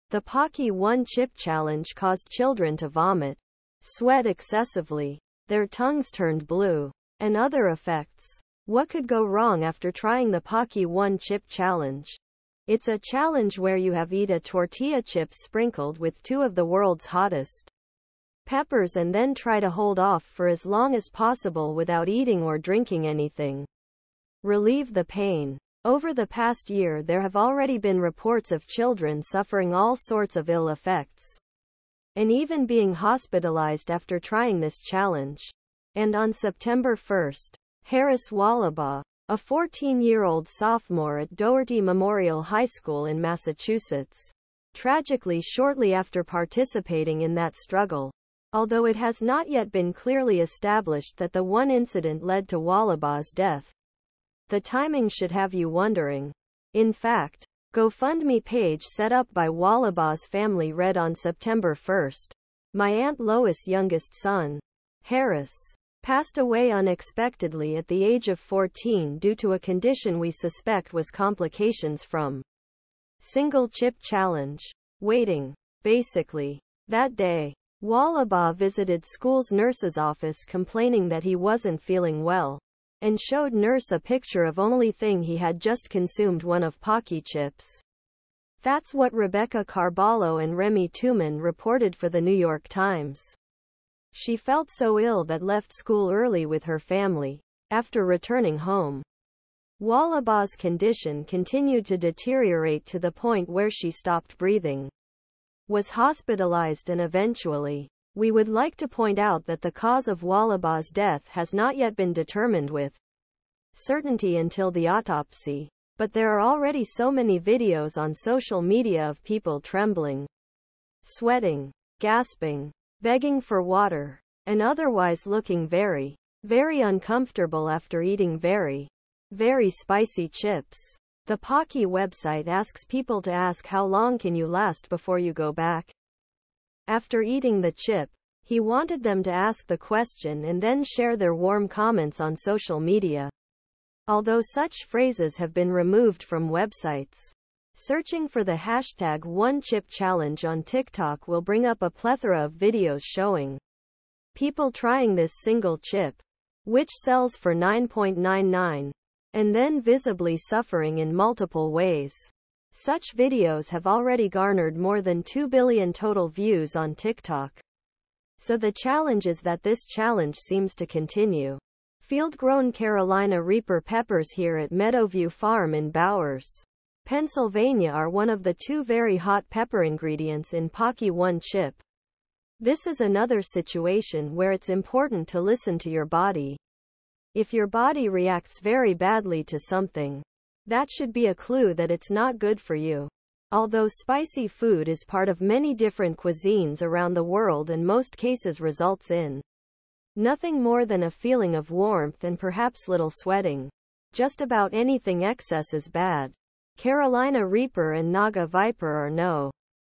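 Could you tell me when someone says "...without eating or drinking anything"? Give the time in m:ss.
0:21.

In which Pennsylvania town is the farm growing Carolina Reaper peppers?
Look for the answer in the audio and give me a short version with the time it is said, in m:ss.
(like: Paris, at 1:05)
Bowers, at 2:55.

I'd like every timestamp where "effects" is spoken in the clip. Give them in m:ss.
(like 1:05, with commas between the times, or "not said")
0:07, 0:30.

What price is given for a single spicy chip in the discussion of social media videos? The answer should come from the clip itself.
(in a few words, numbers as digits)
9.99.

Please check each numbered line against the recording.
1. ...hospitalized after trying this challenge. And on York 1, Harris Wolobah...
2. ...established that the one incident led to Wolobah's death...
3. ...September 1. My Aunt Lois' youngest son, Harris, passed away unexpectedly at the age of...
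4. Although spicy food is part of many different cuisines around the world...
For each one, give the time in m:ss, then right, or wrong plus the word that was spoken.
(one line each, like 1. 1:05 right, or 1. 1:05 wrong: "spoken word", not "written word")
1. 0:32 wrong: "September", not "York"
2. 0:50 right
3. 1:01 right
4. 3:13 right.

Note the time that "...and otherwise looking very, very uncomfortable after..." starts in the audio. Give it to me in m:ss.
2:04.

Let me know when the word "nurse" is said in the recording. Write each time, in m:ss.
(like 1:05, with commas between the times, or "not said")
1:19, 1:23.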